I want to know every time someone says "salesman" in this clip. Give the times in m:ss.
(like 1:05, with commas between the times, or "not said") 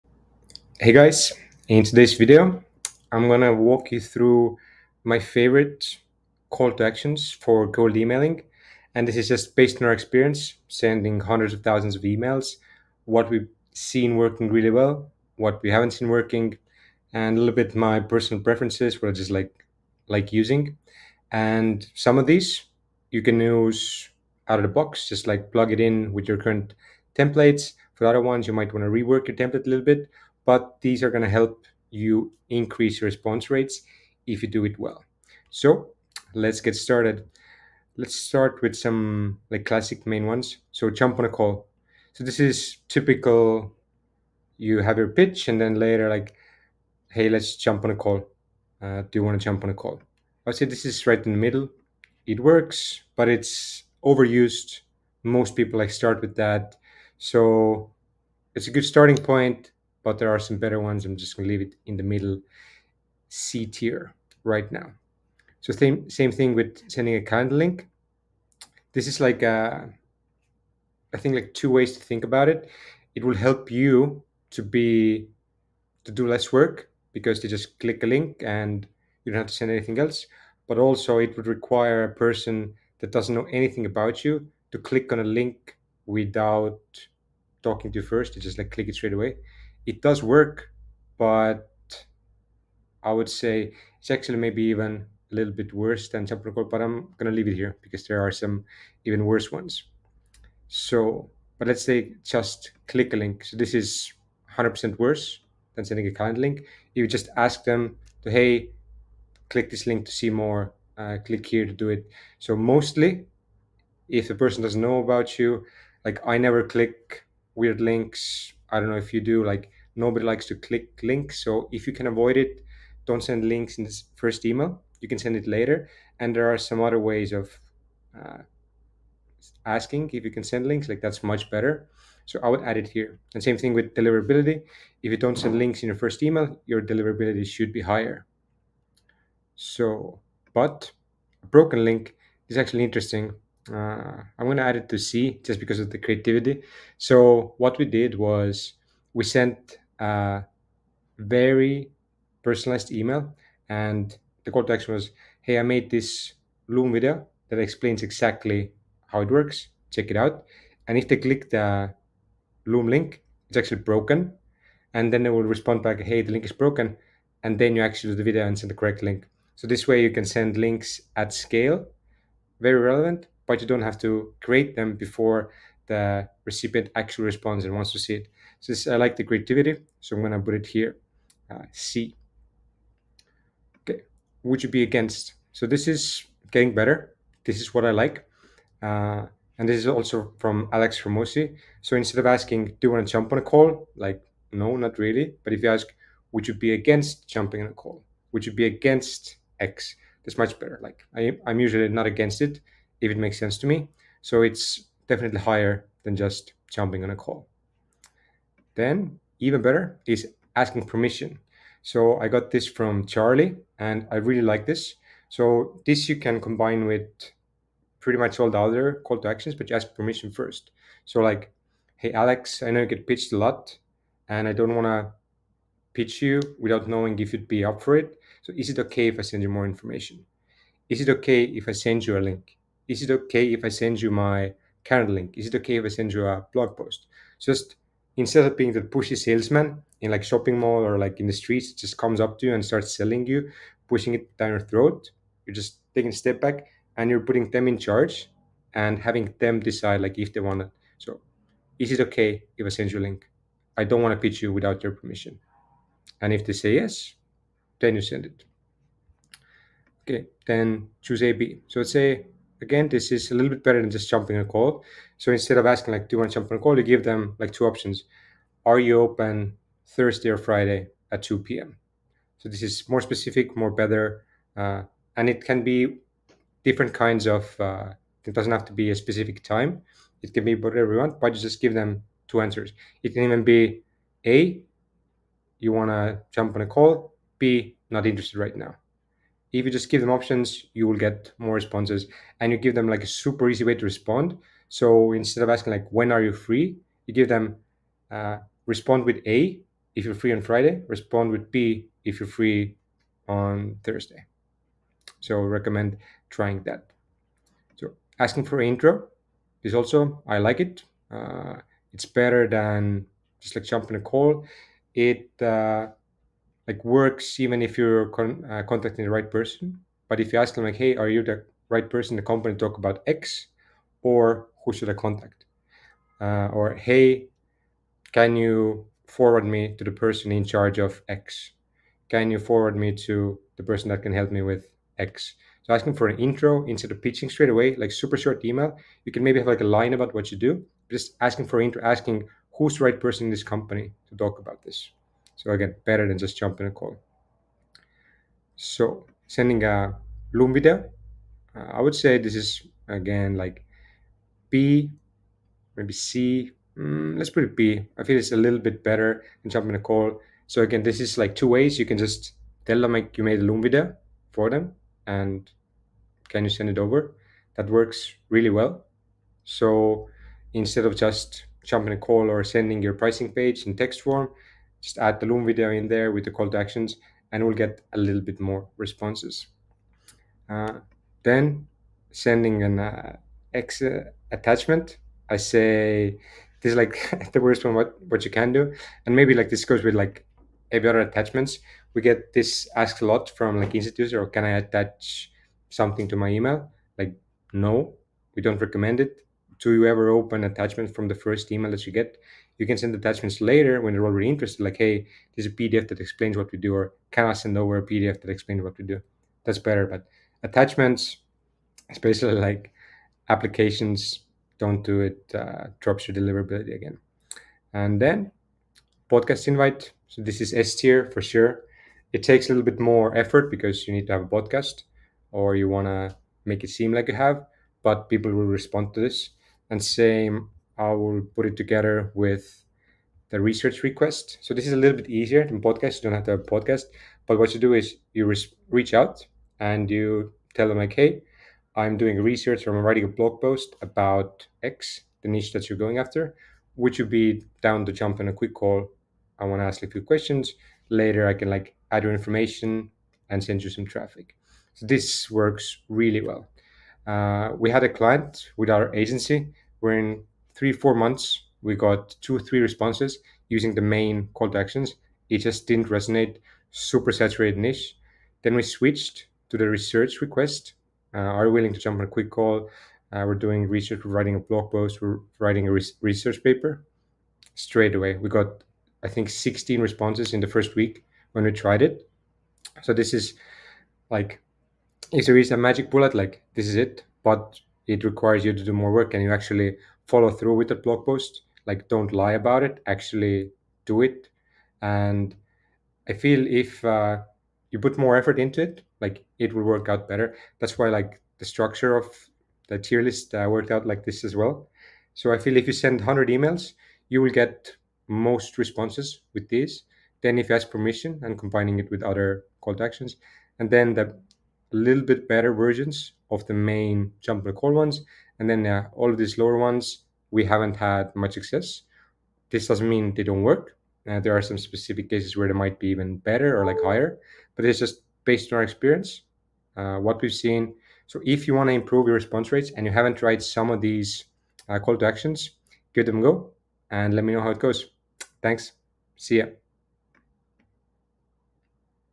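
3:59.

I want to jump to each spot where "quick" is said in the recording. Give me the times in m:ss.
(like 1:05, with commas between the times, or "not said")
7:28, 7:52.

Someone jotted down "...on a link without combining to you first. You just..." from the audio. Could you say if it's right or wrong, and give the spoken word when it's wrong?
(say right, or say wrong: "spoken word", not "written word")
wrong: "talking", not "combining".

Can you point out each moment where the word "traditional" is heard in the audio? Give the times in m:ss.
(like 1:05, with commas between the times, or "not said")
not said.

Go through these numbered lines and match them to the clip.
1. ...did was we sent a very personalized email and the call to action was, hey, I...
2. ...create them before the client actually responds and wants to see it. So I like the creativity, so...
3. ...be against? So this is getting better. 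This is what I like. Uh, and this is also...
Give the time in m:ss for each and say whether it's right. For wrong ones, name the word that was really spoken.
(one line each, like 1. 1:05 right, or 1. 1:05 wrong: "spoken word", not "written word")
1. 2:27 right
2. 2:54 wrong: "recipient", not "client"
3. 3:04 right.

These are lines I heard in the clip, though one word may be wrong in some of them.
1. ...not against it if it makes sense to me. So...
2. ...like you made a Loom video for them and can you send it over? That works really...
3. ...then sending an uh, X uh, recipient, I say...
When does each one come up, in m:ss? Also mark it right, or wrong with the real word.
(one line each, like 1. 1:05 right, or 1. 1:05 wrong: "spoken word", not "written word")
1. 3:21 right
2. 6:02 right
3. 6:21 wrong: "attachment", not "recipient".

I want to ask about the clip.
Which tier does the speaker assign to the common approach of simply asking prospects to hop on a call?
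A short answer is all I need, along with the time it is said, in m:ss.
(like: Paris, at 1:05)
C tier, at 1:03.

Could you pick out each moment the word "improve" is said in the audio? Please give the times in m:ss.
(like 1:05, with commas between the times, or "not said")
8:51.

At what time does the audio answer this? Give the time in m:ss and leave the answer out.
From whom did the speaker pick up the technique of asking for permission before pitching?
3:33.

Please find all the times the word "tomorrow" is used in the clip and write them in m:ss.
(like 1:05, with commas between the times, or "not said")
not said.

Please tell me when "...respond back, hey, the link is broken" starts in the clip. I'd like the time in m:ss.
2:45.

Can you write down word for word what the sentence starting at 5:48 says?
So sending a Loom video, uh, I would say this is again like B, maybe C.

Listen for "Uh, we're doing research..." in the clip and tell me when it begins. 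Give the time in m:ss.
7:53.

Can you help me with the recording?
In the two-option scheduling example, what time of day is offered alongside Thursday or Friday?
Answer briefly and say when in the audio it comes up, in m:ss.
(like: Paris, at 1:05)
2 p.m., at 4:31.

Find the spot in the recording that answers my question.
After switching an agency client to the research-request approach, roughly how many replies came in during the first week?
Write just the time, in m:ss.
7:59.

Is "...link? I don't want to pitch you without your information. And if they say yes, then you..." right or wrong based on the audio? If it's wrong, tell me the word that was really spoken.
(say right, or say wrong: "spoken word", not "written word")
wrong: "permission", not "information".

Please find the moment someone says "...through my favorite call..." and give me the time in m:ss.
0:03.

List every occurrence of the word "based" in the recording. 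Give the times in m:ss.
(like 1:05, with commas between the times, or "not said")
0:09, 8:48.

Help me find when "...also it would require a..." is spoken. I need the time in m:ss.
1:20.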